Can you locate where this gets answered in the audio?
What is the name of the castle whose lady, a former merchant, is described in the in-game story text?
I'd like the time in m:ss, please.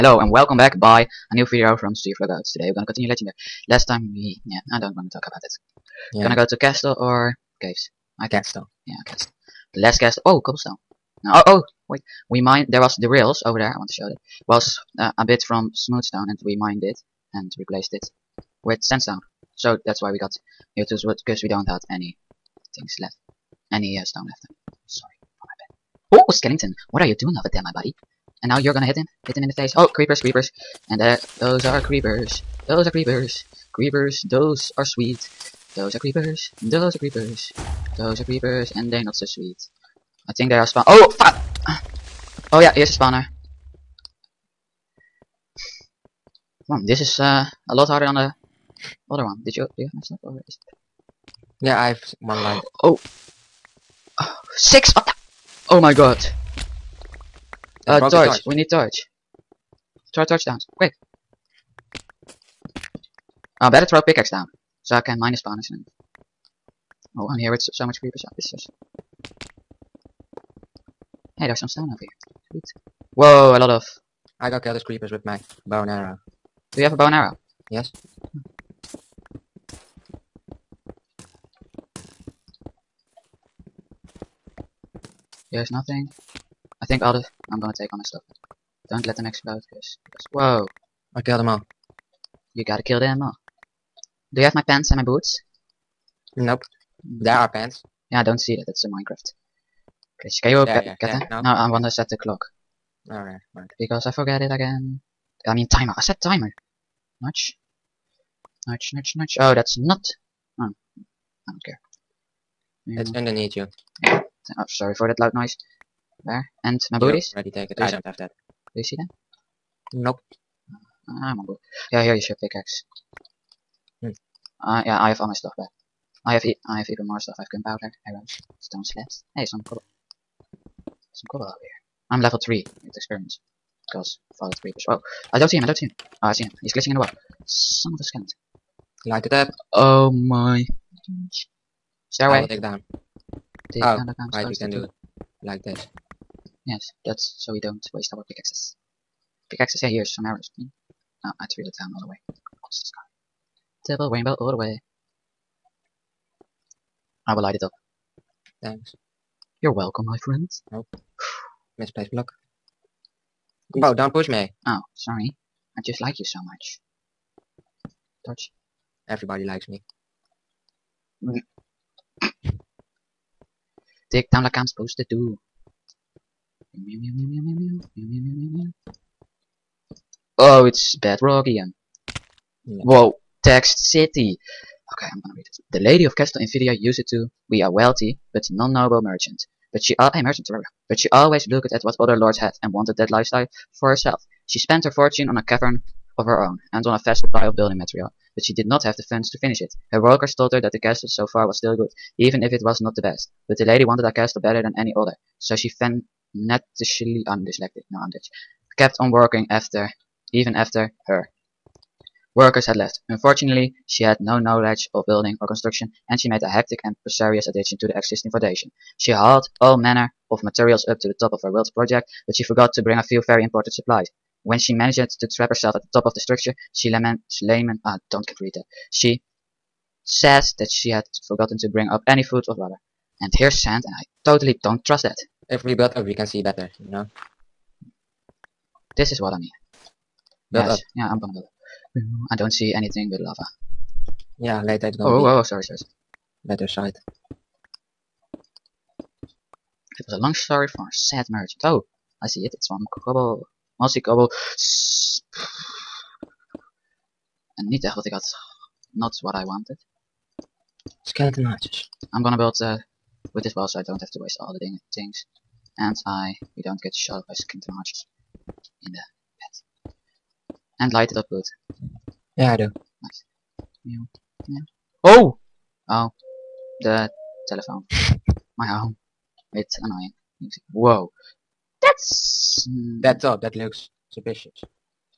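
3:06.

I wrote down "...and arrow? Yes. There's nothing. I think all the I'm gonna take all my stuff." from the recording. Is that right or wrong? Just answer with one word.
right.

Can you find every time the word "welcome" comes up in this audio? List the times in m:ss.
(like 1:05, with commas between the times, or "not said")
0:00, 2:39.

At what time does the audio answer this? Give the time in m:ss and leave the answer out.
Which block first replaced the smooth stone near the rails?
0:18.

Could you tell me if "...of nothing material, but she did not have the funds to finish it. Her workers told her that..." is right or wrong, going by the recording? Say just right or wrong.
wrong.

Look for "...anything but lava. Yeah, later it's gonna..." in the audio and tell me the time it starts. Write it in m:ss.
4:02.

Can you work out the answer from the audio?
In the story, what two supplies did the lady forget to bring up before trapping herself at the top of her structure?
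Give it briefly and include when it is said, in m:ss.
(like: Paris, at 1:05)
Food or water, at 3:52.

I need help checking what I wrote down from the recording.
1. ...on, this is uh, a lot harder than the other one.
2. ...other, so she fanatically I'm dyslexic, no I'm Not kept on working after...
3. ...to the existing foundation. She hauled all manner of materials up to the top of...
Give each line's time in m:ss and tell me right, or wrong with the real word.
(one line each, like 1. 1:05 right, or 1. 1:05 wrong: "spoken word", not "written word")
1. 0:46 right
2. 3:24 wrong: "Dutch", not "Not"
3. 3:37 right.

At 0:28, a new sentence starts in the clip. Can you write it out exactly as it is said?
And now you're gonna hit him?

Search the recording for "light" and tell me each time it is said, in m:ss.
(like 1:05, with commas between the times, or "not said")
2:19, 2:37, 4:30.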